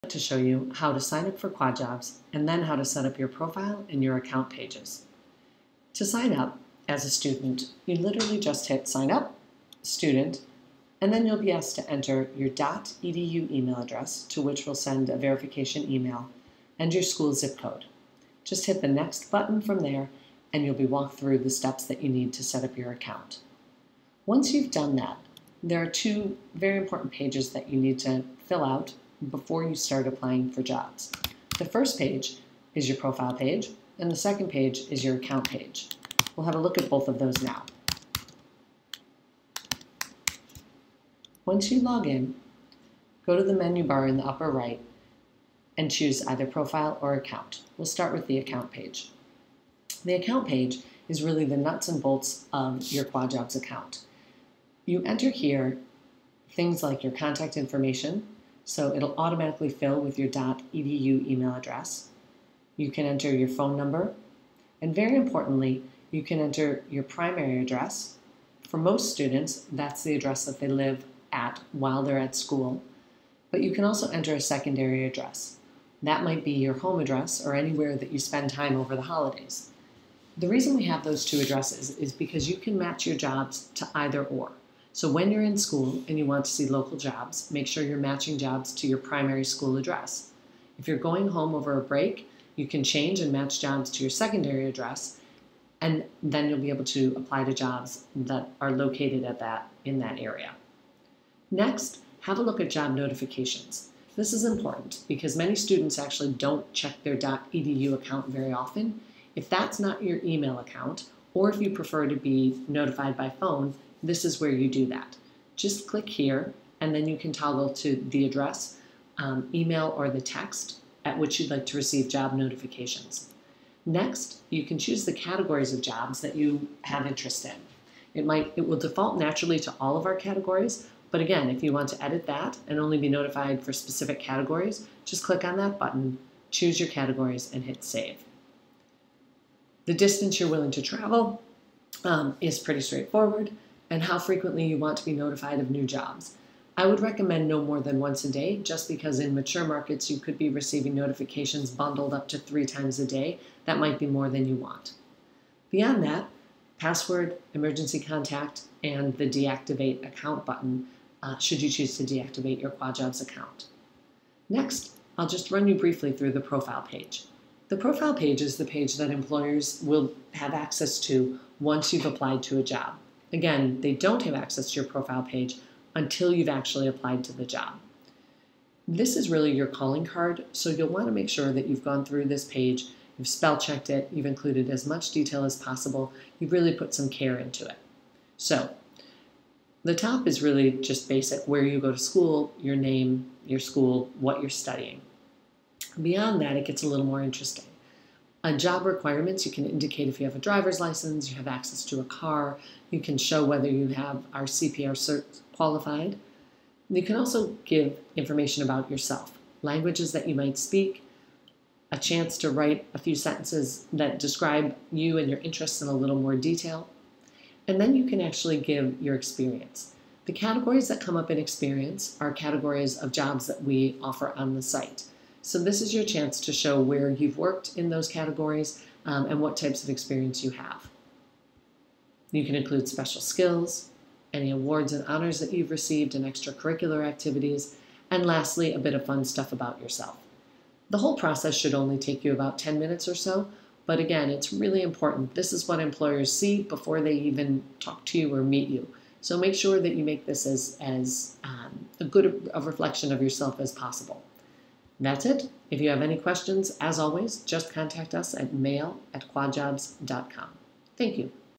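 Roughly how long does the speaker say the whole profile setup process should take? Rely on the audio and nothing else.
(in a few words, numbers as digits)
10 minutes.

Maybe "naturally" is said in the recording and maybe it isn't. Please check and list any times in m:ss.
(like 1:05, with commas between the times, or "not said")
2:09.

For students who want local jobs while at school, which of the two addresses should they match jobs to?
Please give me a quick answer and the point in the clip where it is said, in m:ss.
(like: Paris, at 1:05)
primary address, at 1:28.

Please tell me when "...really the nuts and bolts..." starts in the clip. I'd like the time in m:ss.
0:51.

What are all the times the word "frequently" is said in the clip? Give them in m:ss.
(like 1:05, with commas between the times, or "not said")
2:24.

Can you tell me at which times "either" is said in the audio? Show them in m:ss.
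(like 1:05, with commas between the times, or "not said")
0:46, 1:23.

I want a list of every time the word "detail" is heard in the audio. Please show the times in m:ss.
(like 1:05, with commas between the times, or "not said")
3:05, 3:36.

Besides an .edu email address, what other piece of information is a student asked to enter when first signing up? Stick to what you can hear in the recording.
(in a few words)
school zip code.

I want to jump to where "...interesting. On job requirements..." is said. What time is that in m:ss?
3:17.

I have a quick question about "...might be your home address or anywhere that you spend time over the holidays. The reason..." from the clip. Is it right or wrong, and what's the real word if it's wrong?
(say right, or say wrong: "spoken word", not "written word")
right.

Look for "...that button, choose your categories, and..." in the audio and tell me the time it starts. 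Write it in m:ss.
2:15.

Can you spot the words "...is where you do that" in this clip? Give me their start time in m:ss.
1:54.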